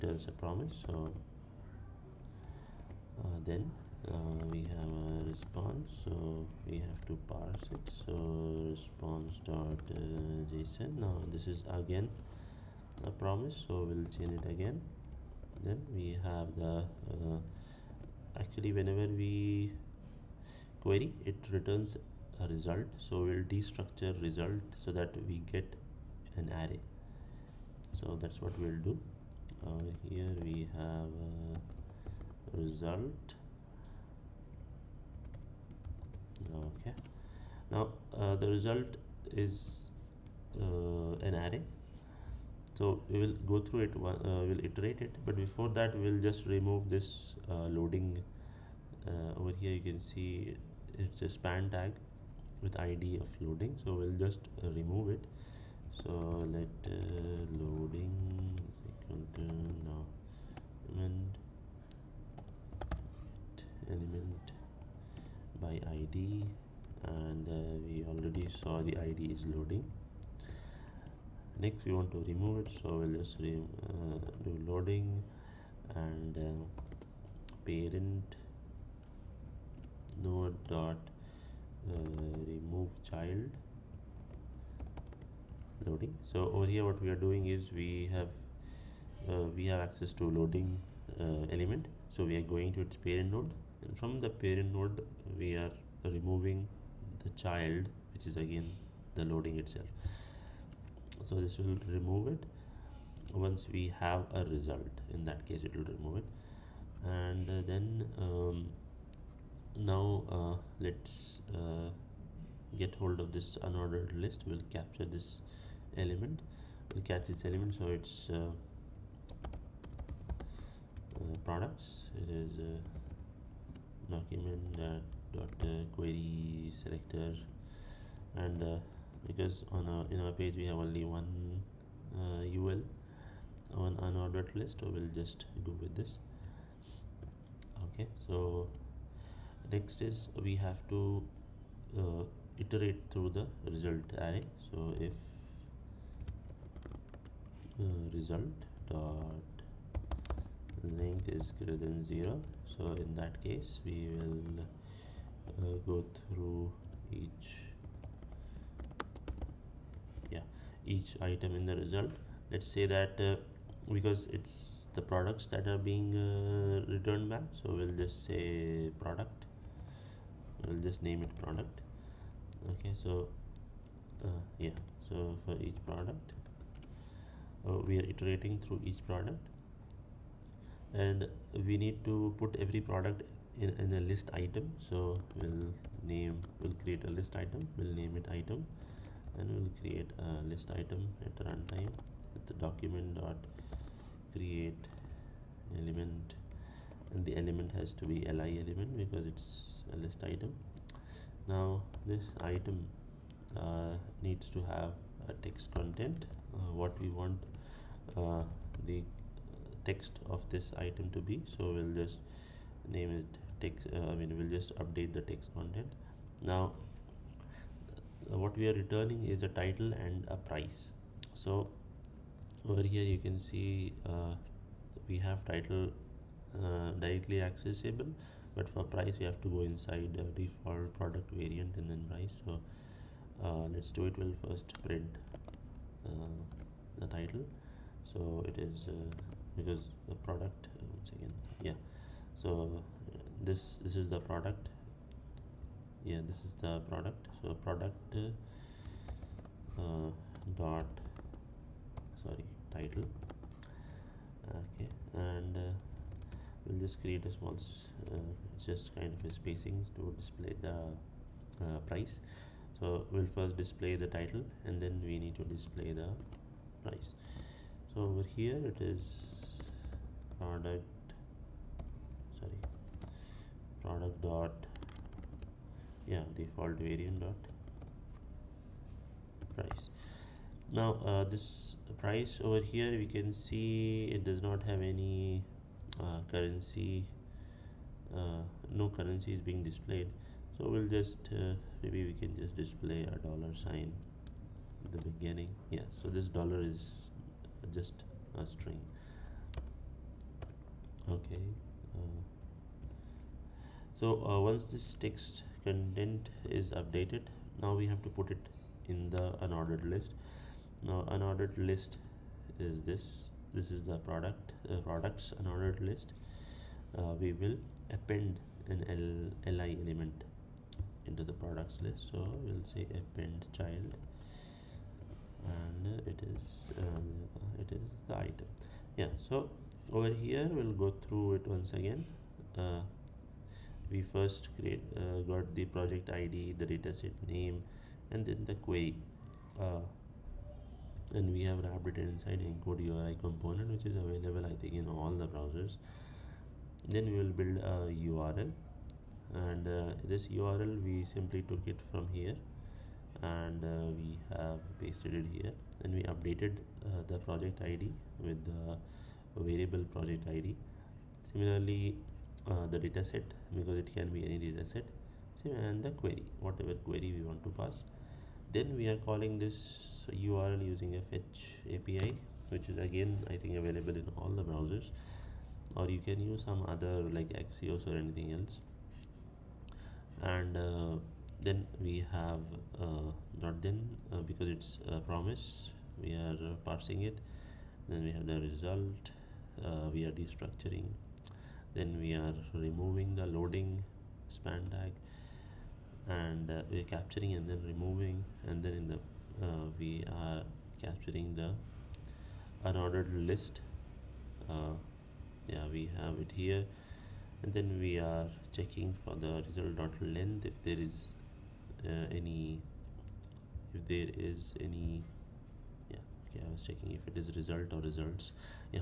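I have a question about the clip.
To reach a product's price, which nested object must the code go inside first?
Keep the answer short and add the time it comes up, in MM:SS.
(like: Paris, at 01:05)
default product variant, at 03:50.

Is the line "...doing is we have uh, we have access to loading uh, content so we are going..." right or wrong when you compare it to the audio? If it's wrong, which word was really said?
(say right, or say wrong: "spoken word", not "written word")
wrong: "element", not "content".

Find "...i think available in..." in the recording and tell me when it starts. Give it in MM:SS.
06:13.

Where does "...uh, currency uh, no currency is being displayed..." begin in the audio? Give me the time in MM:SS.
04:45.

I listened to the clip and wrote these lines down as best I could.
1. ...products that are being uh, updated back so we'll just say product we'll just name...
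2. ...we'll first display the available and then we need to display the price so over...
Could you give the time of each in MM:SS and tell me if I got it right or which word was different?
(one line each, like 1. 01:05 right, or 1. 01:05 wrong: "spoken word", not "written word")
1. 02:45 wrong: "returned", not "updated"
2. 04:23 wrong: "title", not "available".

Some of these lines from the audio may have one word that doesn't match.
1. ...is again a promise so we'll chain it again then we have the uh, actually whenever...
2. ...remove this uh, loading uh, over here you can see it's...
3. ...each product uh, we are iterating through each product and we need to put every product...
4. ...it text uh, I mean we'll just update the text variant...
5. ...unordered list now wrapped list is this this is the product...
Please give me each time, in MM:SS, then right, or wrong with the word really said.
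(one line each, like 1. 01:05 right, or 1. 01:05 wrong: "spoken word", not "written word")
1. 00:11 right
2. 00:46 right
3. 02:55 right
4. 03:33 wrong: "content", not "variant"
5. 05:09 wrong: "unordered", not "wrapped".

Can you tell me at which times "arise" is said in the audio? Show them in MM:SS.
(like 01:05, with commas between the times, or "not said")
not said.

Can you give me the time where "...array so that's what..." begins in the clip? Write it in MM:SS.
00:26.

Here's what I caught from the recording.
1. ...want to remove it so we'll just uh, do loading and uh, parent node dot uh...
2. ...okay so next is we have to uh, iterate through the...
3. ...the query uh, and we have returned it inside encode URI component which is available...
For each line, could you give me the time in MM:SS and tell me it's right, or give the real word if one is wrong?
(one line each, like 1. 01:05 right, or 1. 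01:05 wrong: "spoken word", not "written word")
1. 01:11 right
2. 02:17 right
3. 05:38 wrong: "wrapped", not "returned".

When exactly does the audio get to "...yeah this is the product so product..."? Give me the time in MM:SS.
04:06.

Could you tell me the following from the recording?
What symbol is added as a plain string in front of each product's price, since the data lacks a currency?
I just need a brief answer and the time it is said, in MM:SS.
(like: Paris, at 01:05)
dollar sign, at 04:53.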